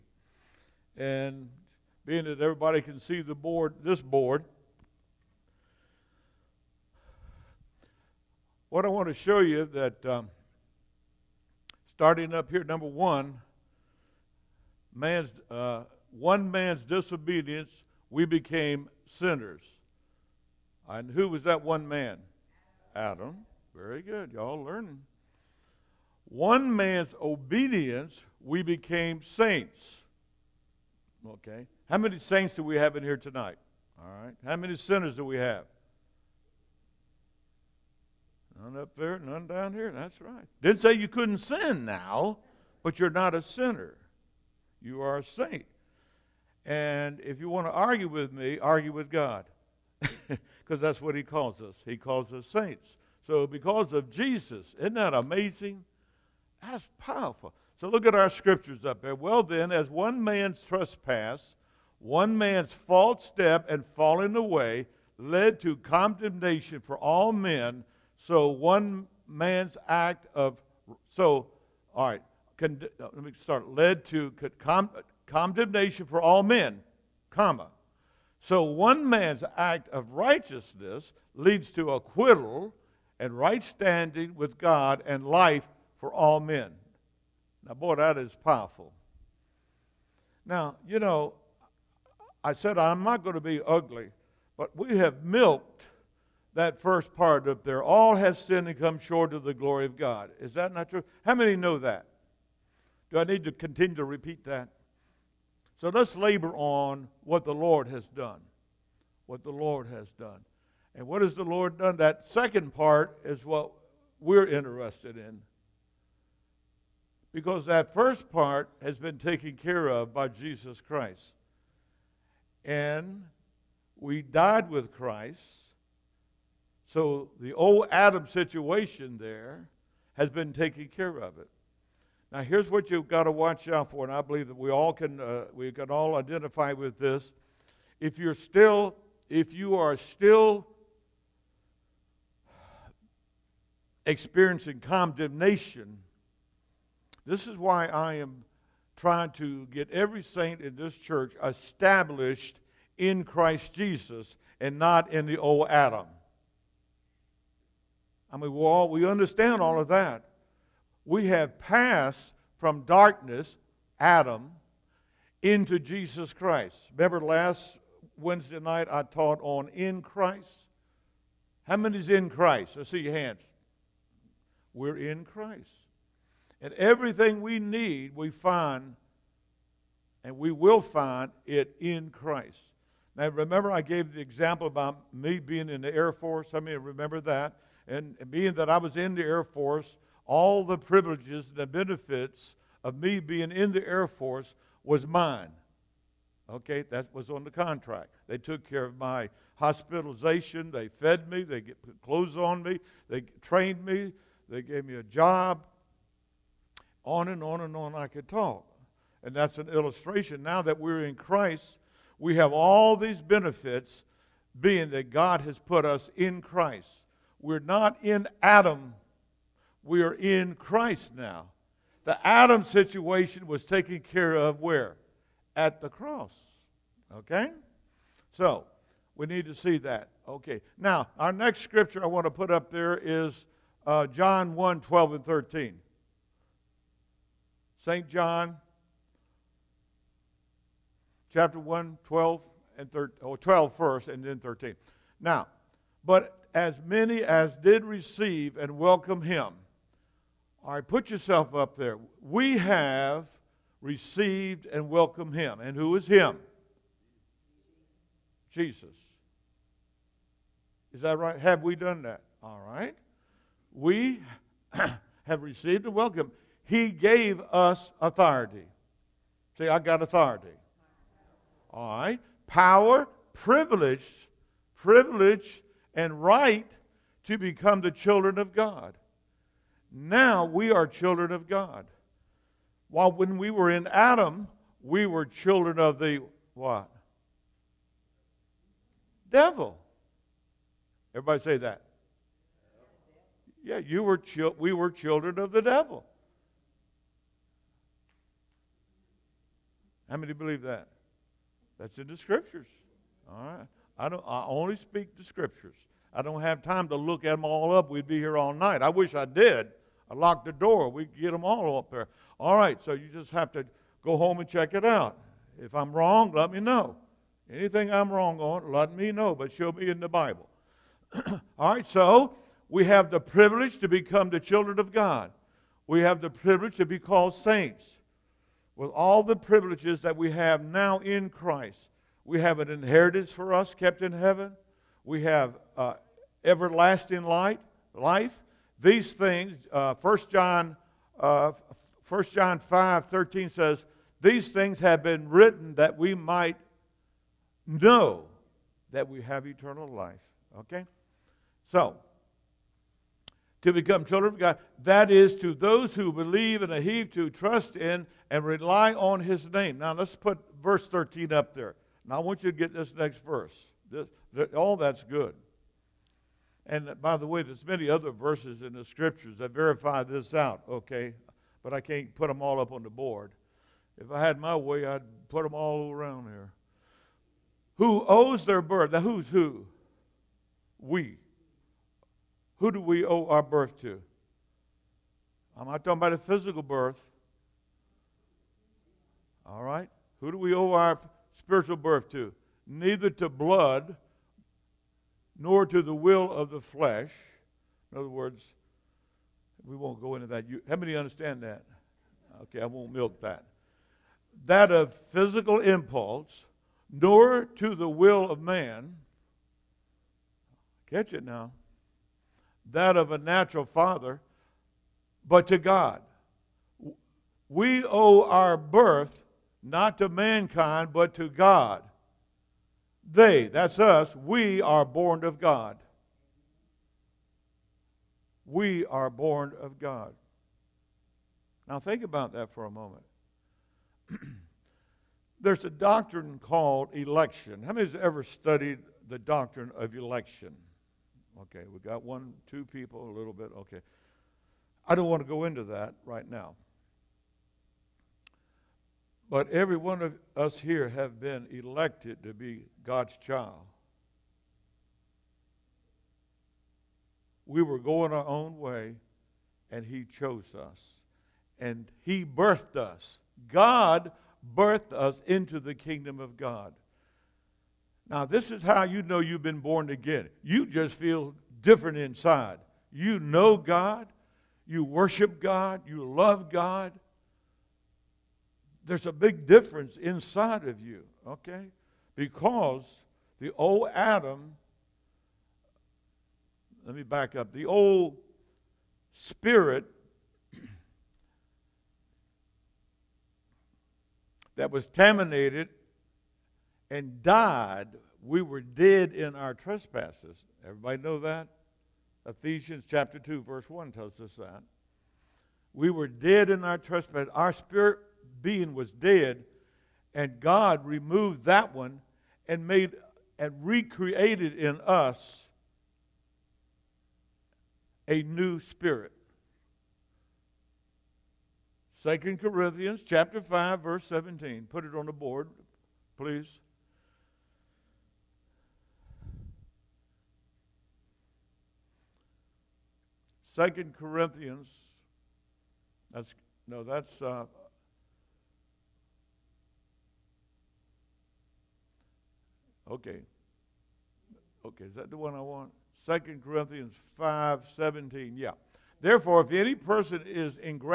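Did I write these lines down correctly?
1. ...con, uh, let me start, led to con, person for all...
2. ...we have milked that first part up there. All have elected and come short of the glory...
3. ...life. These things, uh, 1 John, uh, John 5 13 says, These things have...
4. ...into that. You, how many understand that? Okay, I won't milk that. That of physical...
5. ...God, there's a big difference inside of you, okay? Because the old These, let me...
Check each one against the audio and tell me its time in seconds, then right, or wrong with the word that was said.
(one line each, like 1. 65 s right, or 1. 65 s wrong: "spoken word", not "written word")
1. 72 s wrong: "condemnation", not "person"
2. 94 s wrong: "sinned", not "elected"
3. 337 s right
4. 400 s right
5. 476 s wrong: "Adam", not "These".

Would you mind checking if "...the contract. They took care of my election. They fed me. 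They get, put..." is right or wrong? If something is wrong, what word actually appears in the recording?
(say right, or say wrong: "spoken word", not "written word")
wrong: "hospitalization", not "election".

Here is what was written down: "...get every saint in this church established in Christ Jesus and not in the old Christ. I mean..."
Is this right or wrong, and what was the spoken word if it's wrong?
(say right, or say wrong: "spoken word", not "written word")
wrong: "Adam", not "Christ".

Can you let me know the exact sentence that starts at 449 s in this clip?
But every one of us here have been elected to be God's child.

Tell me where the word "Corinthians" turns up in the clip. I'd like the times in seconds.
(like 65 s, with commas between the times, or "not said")
522 s, 533 s, 546 s.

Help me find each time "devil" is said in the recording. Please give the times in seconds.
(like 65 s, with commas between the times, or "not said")
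289 s, 295 s.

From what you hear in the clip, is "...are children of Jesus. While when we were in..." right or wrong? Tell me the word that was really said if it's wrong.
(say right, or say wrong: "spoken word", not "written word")
wrong: "God", not "Jesus".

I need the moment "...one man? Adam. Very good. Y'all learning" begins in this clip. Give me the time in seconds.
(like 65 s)
21 s.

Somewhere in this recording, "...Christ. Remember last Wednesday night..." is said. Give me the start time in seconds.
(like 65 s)
166 s.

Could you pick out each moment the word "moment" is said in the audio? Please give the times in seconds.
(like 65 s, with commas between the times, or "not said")
432 s.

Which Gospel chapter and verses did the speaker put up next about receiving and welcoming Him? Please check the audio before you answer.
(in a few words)
John 1:12-13.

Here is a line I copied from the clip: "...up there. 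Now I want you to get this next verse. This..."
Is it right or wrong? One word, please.
right.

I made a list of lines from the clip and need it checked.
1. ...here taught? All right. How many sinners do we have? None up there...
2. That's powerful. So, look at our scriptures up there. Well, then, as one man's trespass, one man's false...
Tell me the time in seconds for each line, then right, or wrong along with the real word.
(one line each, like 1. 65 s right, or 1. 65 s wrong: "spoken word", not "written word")
1. 33 s wrong: "tonight", not "taught"
2. 56 s right.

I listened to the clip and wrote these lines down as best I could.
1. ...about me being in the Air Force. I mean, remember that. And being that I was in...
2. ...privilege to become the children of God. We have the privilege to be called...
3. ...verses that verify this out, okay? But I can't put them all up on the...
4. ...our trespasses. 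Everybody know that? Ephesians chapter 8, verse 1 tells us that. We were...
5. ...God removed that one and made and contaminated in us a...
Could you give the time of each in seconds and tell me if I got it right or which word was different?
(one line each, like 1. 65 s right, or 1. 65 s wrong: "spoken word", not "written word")
1. 184 s right
2. 323 s right
3. 368 s wrong: "scriptures", not "verses"
4. 499 s wrong: "2", not "8"
5. 510 s wrong: "recreated", not "contaminated".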